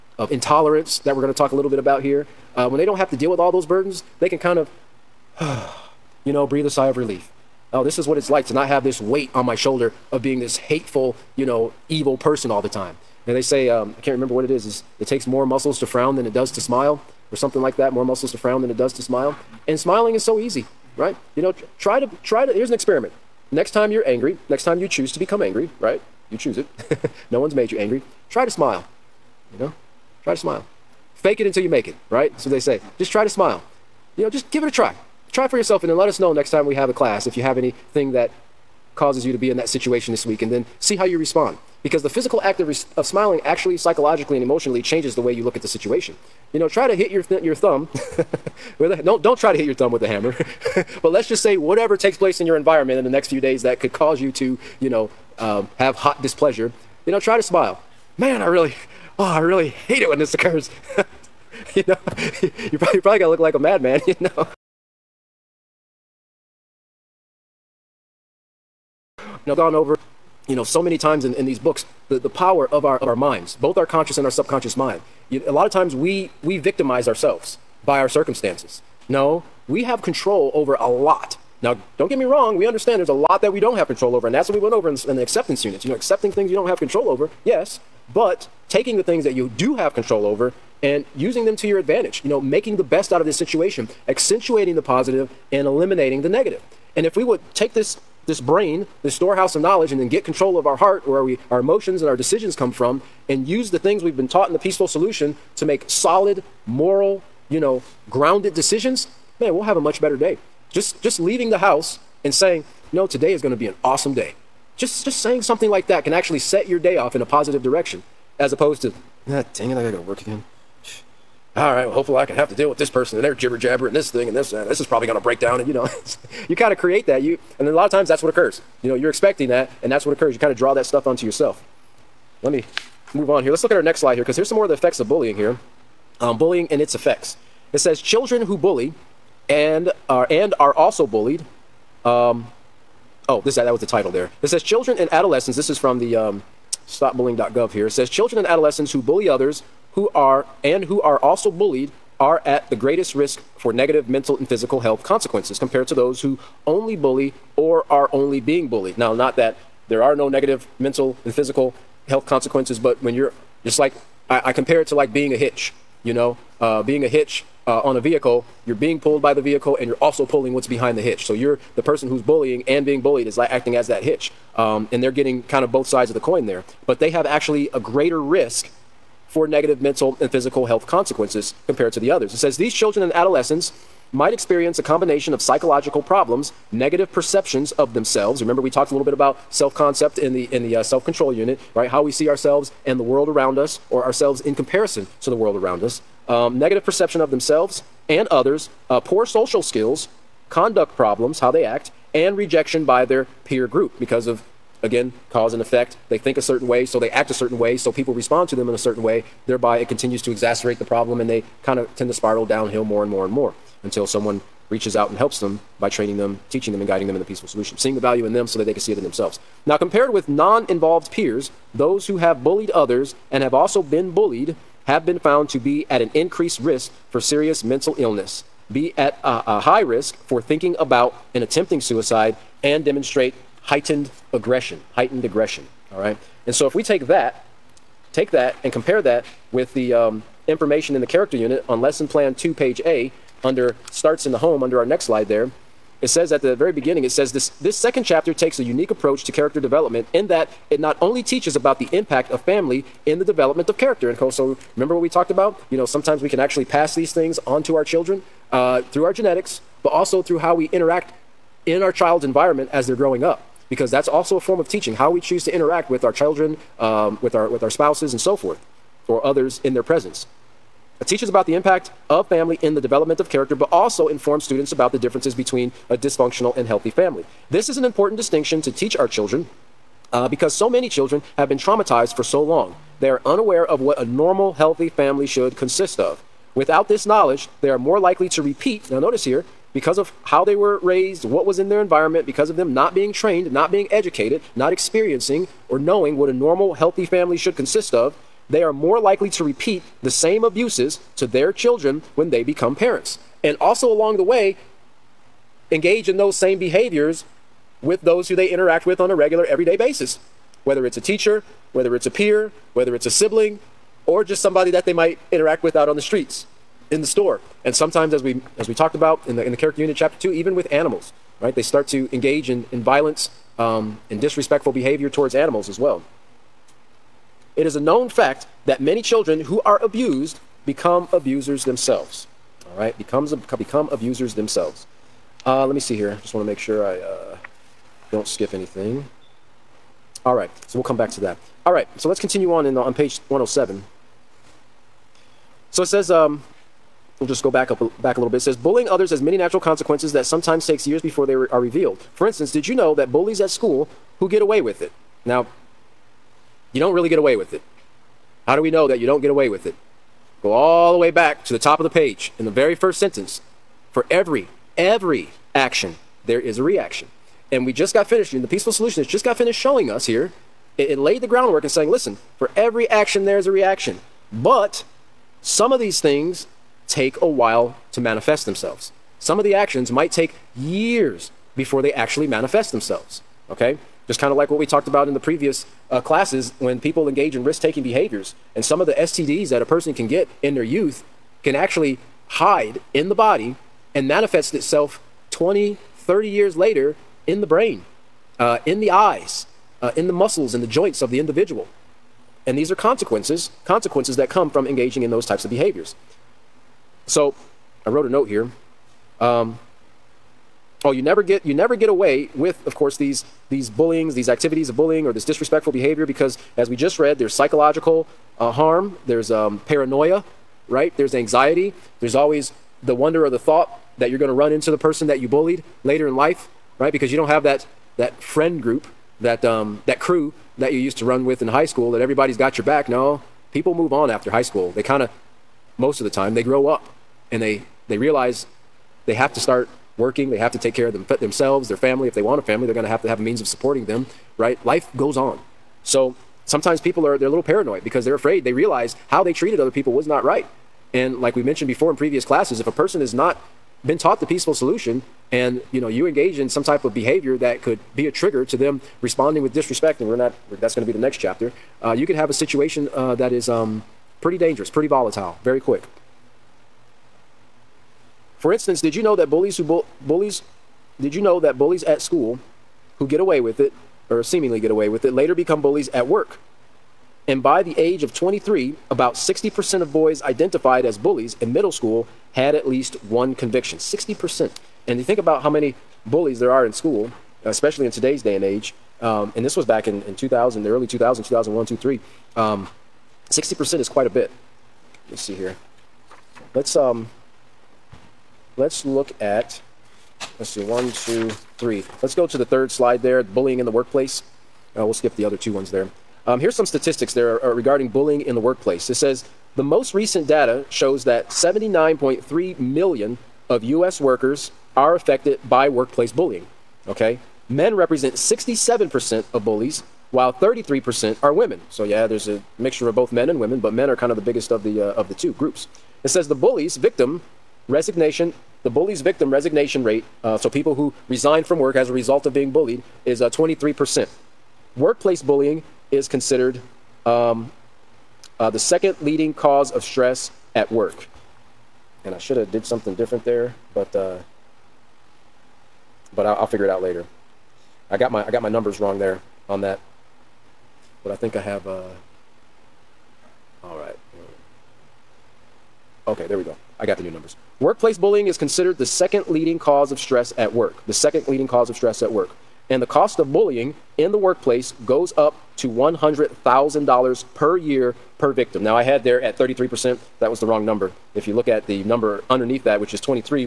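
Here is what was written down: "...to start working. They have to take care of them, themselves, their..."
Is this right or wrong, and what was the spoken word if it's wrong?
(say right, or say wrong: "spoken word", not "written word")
right.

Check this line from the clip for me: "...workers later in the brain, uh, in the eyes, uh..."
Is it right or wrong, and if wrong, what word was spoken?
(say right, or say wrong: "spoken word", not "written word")
wrong: "years", not "workers".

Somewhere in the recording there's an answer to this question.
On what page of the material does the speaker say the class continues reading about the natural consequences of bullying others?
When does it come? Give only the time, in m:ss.
5:42.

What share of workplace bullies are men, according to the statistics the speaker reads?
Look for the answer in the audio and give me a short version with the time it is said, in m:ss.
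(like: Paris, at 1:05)
67%, at 8:38.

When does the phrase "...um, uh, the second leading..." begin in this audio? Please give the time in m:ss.
8:57.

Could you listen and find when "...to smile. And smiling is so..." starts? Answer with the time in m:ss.
0:18.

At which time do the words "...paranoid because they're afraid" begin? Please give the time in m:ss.
7:27.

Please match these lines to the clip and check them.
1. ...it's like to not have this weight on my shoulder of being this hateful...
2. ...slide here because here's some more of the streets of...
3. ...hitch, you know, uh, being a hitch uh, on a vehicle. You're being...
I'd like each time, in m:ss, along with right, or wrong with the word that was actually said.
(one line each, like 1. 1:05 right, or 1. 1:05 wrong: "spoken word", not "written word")
1. 0:08 right
2. 2:13 wrong: "effects", not "streets"
3. 2:45 right.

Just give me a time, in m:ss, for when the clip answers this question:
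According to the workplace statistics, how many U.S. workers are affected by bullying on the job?
8:31.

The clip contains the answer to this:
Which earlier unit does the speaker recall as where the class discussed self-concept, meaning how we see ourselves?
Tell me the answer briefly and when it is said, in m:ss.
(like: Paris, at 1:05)
self-control unit, at 3:10.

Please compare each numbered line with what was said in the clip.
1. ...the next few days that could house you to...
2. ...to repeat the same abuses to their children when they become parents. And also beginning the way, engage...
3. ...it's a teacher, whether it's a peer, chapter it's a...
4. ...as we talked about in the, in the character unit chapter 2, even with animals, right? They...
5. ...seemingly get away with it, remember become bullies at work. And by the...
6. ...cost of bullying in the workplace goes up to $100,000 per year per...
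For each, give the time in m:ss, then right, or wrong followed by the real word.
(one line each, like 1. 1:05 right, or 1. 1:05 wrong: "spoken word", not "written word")
1. 0:53 wrong: "cause", not "house"
2. 4:59 wrong: "along", not "beginning"
3. 5:10 wrong: "whether", not "chapter"
4. 5:18 right
5. 7:54 wrong: "later", not "remember"
6. 9:22 right.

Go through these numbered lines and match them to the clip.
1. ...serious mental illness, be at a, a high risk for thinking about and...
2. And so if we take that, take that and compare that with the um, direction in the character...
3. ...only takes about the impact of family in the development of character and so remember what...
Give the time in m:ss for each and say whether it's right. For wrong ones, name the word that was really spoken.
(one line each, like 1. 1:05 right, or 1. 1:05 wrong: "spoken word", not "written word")
1. 3:47 right
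2. 3:56 wrong: "information", not "direction"
3. 4:10 wrong: "teaches", not "takes".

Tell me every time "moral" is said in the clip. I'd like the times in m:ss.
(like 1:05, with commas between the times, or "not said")
1:46.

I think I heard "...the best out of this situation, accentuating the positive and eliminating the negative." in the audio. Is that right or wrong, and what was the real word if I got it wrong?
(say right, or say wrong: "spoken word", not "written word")
right.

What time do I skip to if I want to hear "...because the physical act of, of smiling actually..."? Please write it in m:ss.
0:41.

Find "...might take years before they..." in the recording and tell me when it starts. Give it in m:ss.
6:19.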